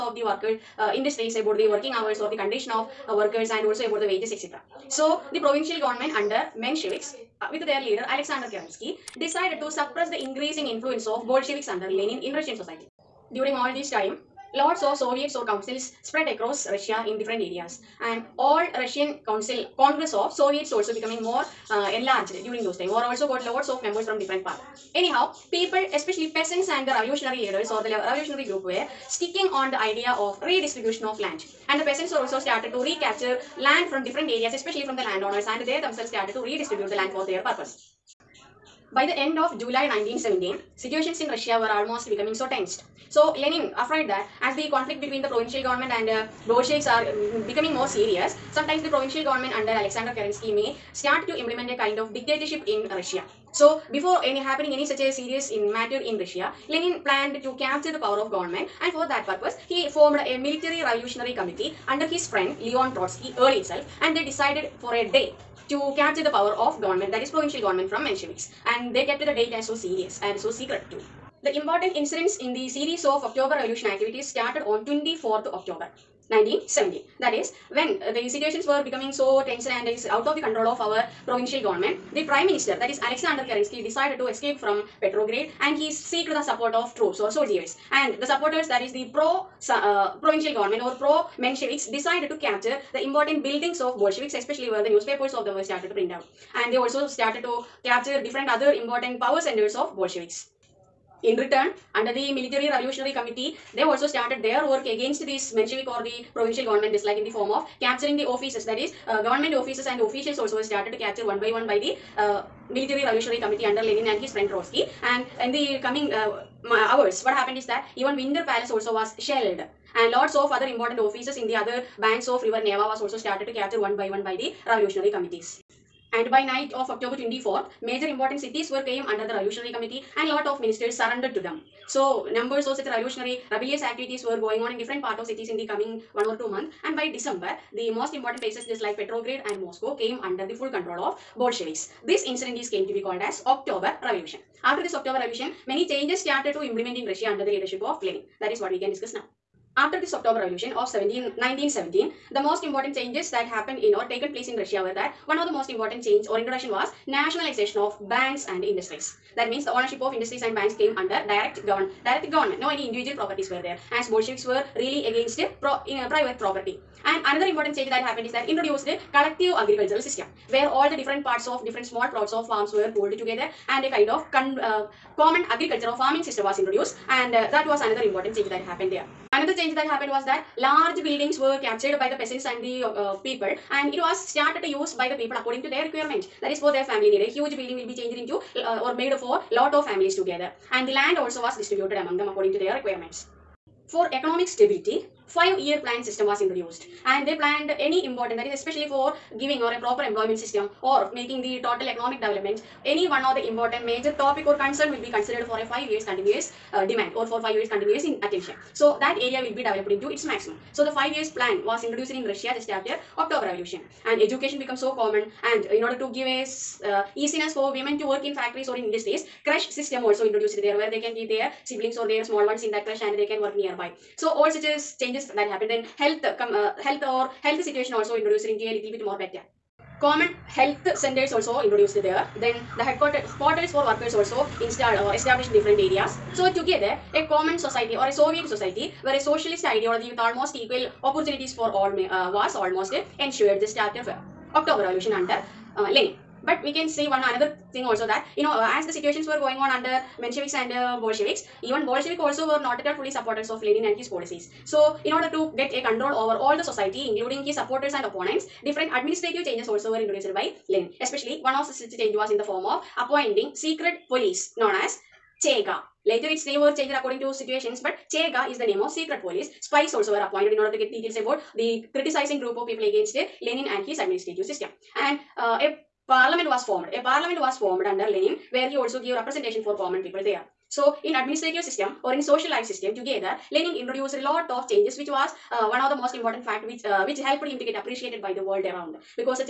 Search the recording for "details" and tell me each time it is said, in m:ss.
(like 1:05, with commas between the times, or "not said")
4:30.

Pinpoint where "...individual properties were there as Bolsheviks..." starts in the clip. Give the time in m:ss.
2:42.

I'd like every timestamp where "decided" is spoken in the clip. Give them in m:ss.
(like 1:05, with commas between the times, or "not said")
0:09, 1:04, 1:23, 1:31.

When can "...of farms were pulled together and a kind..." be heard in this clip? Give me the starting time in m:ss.
2:52.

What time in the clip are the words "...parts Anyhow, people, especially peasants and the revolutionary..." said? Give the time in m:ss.
0:24.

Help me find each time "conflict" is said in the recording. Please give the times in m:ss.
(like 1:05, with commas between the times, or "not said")
0:44.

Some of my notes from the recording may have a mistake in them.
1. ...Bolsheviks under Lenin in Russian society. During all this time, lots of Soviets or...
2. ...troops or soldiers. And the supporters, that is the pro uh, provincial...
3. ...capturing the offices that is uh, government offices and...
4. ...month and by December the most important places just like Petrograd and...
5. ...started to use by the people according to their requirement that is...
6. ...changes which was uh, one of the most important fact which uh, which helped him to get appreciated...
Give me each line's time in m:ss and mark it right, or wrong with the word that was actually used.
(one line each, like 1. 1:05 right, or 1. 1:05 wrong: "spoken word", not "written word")
1. 0:11 right
2. 1:26 right
3. 1:47 right
4. 2:16 right
5. 3:04 right
6. 4:44 right.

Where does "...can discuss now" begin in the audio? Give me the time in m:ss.
2:28.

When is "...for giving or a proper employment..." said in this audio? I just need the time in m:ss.
3:18.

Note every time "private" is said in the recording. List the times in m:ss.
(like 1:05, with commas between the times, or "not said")
2:46.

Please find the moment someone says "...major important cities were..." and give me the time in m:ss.
2:07.